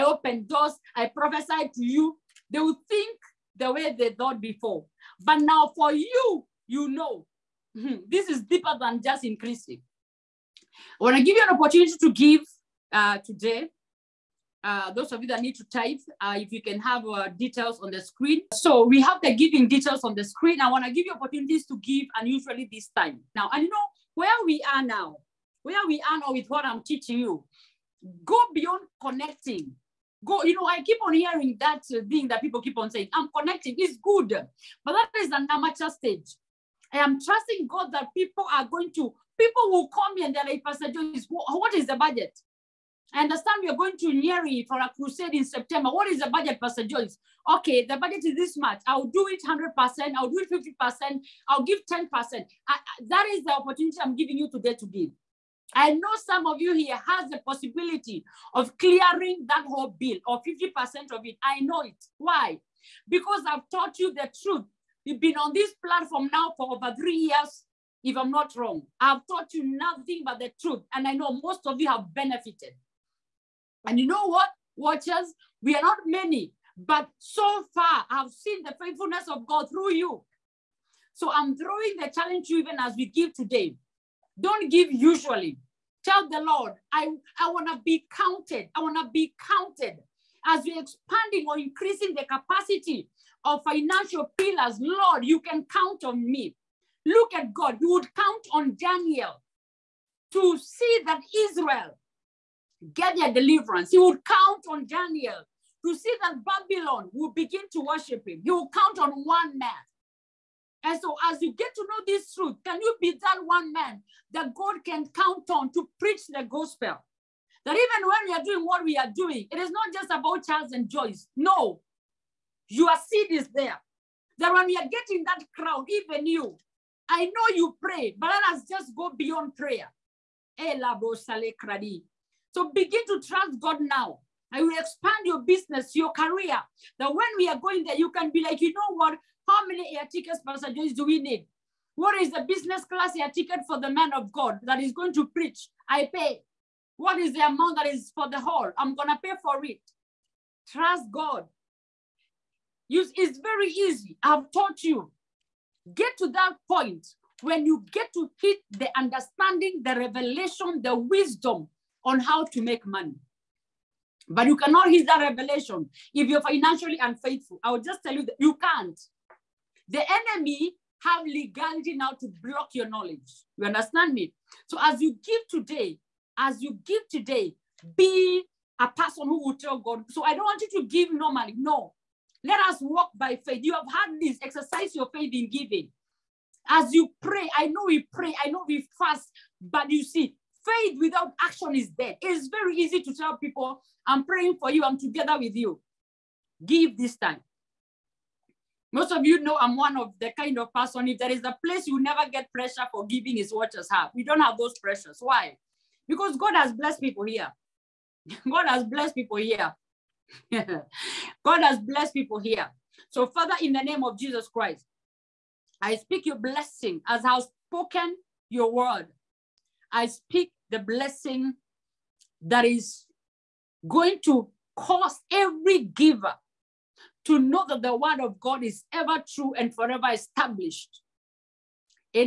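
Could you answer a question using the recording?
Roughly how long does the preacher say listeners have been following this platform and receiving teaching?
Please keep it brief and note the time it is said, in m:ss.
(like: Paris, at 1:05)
Over three years, at 1:06.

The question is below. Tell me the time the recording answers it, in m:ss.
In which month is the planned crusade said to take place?
0:45.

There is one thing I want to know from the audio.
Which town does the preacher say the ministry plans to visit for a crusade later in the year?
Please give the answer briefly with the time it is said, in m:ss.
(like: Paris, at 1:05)
Nyeri, at 0:44.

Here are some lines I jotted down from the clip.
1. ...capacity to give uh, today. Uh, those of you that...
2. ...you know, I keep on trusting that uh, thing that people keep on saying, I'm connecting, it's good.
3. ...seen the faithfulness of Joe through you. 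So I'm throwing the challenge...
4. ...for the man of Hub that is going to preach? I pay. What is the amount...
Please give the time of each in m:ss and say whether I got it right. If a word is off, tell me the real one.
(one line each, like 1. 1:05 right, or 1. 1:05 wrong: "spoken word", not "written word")
1. 0:11 wrong: "opportunity", not "capacity"
2. 0:30 wrong: "hearing", not "trusting"
3. 1:18 wrong: "God", not "Joe"
4. 2:23 wrong: "God", not "Hub".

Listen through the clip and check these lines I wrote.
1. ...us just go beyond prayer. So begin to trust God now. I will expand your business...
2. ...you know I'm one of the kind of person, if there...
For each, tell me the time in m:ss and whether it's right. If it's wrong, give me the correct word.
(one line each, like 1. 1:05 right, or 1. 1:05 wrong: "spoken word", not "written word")
1. 2:08 right
2. 3:19 right.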